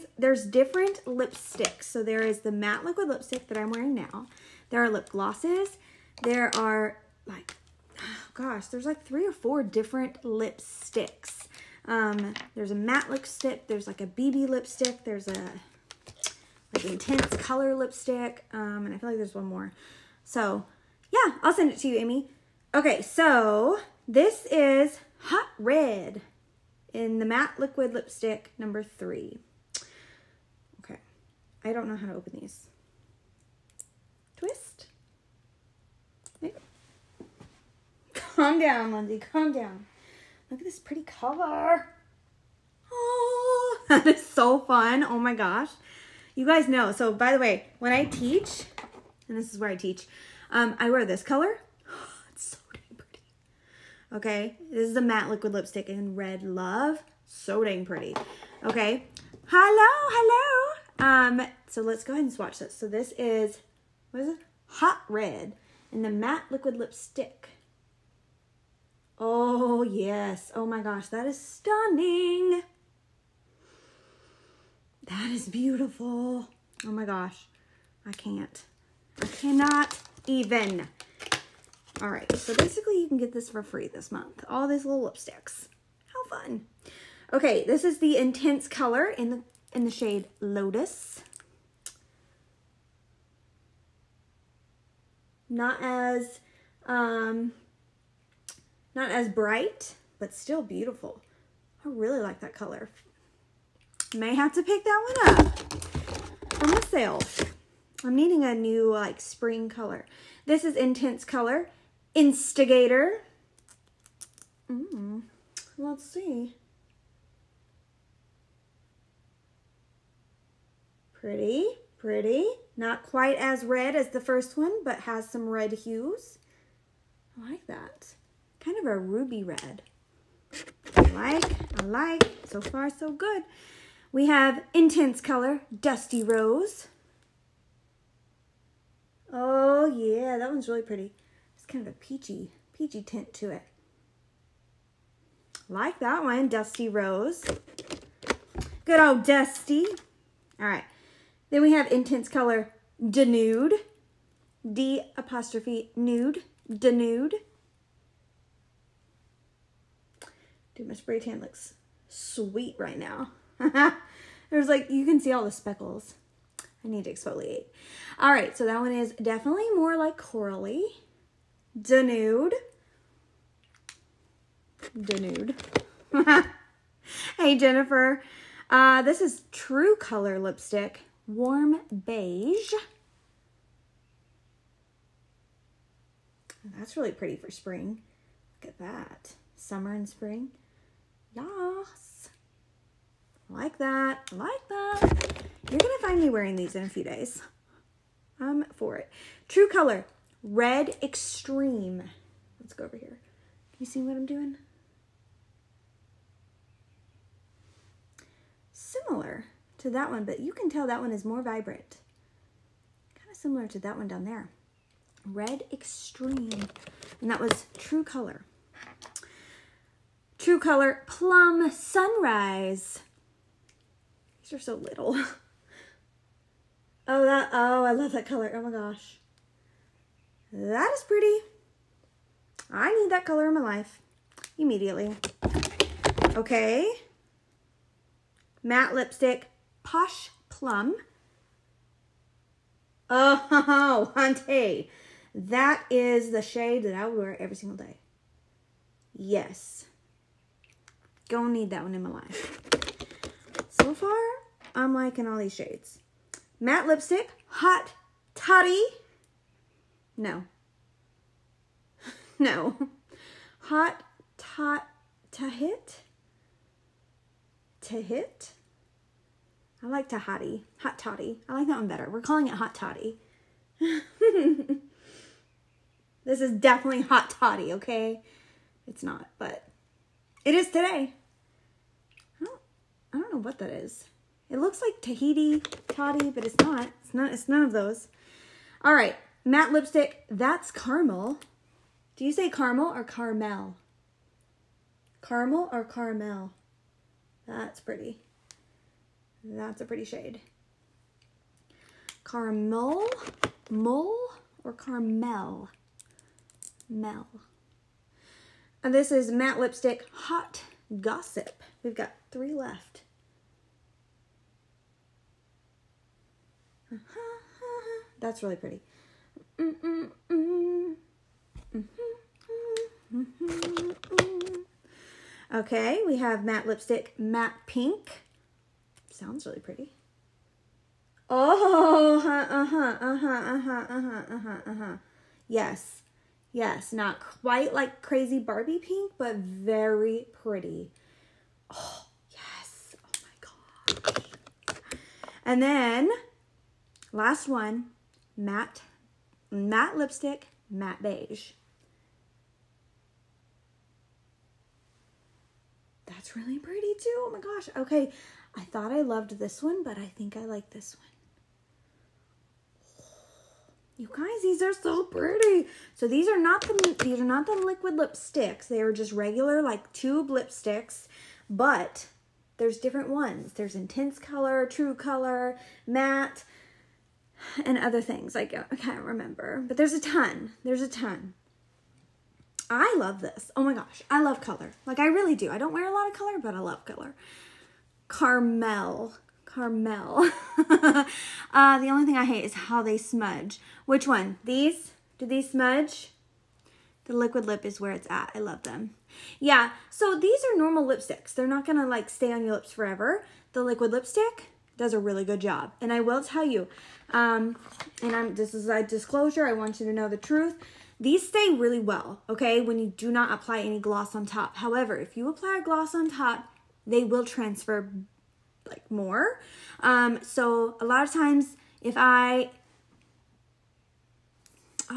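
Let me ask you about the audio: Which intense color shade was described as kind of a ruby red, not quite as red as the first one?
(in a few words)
Instigator.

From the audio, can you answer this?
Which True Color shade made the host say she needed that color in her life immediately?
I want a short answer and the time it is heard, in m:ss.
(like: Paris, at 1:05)
Plum Sunrise, at 3:41.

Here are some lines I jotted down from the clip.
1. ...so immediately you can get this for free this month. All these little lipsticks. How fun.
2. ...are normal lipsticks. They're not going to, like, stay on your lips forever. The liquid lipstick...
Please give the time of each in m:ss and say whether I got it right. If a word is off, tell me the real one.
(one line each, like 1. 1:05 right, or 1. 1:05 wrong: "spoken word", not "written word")
1. 1:22 wrong: "basically", not "immediately"
2. 6:40 right.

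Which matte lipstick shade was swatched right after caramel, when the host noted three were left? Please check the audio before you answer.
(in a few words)
Hot Gossip.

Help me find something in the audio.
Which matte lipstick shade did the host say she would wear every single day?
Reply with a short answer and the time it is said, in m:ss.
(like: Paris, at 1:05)
Posh Plum, at 3:59.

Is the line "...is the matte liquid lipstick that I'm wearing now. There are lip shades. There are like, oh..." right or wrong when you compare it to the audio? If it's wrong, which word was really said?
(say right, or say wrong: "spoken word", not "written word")
wrong: "glosses", not "shades".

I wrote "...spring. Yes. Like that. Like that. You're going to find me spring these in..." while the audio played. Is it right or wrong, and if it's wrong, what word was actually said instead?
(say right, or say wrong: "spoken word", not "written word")
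wrong: "wearing", not "spring".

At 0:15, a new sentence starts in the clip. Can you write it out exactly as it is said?
There's a like intense color lipstick.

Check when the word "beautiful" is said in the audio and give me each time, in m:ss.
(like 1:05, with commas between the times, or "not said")
1:15, 1:40.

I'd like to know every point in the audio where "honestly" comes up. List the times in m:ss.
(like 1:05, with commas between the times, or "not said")
not said.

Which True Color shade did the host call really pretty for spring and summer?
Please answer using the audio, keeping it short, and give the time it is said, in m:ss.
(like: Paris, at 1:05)
Warm Beige, at 3:01.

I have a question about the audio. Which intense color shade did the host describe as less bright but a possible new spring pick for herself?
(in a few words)
Lotus.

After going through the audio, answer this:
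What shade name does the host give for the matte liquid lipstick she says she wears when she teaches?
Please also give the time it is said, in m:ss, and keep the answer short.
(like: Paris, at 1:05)
Red Love, at 0:56.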